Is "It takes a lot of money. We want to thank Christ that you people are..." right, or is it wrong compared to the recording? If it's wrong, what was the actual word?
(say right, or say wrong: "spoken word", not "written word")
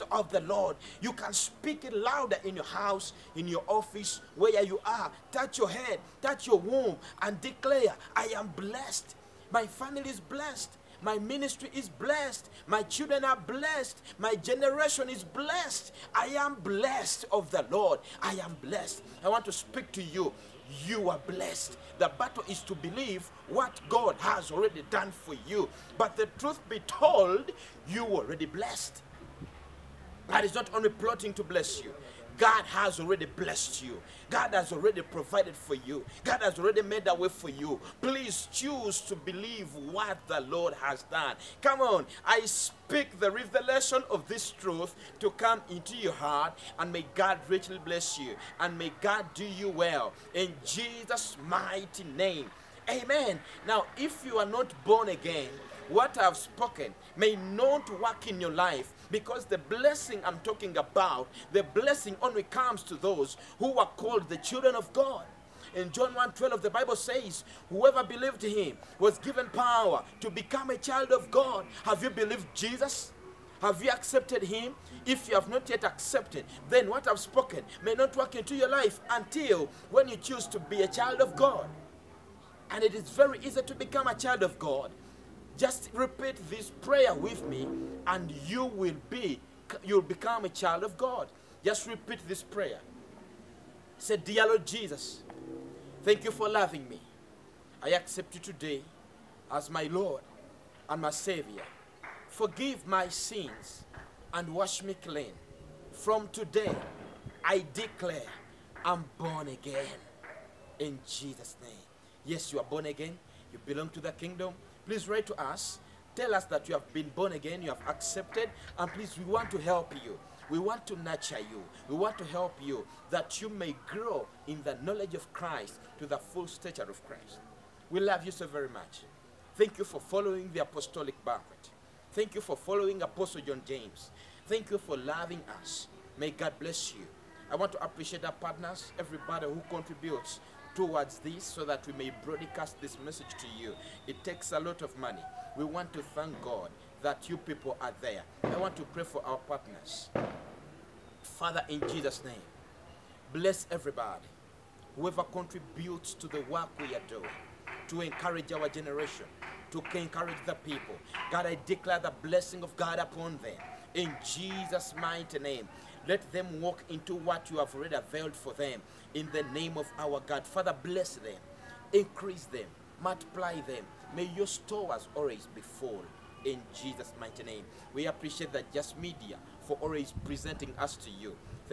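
wrong: "God", not "Christ".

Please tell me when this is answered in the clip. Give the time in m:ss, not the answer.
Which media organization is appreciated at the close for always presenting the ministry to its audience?
2:58.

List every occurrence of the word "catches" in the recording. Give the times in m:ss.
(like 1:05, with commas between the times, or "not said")
not said.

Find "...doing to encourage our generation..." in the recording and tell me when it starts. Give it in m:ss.
2:37.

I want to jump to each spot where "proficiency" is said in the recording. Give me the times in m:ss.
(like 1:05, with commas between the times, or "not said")
not said.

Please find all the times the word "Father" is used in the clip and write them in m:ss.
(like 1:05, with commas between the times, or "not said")
2:31, 2:50.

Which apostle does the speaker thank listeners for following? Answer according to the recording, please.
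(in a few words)
Apostle John James.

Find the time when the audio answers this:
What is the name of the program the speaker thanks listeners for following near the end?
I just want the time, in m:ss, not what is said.
2:10.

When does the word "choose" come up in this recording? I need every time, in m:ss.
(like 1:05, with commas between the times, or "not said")
0:38, 1:20.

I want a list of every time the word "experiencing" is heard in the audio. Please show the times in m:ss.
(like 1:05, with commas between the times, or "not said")
not said.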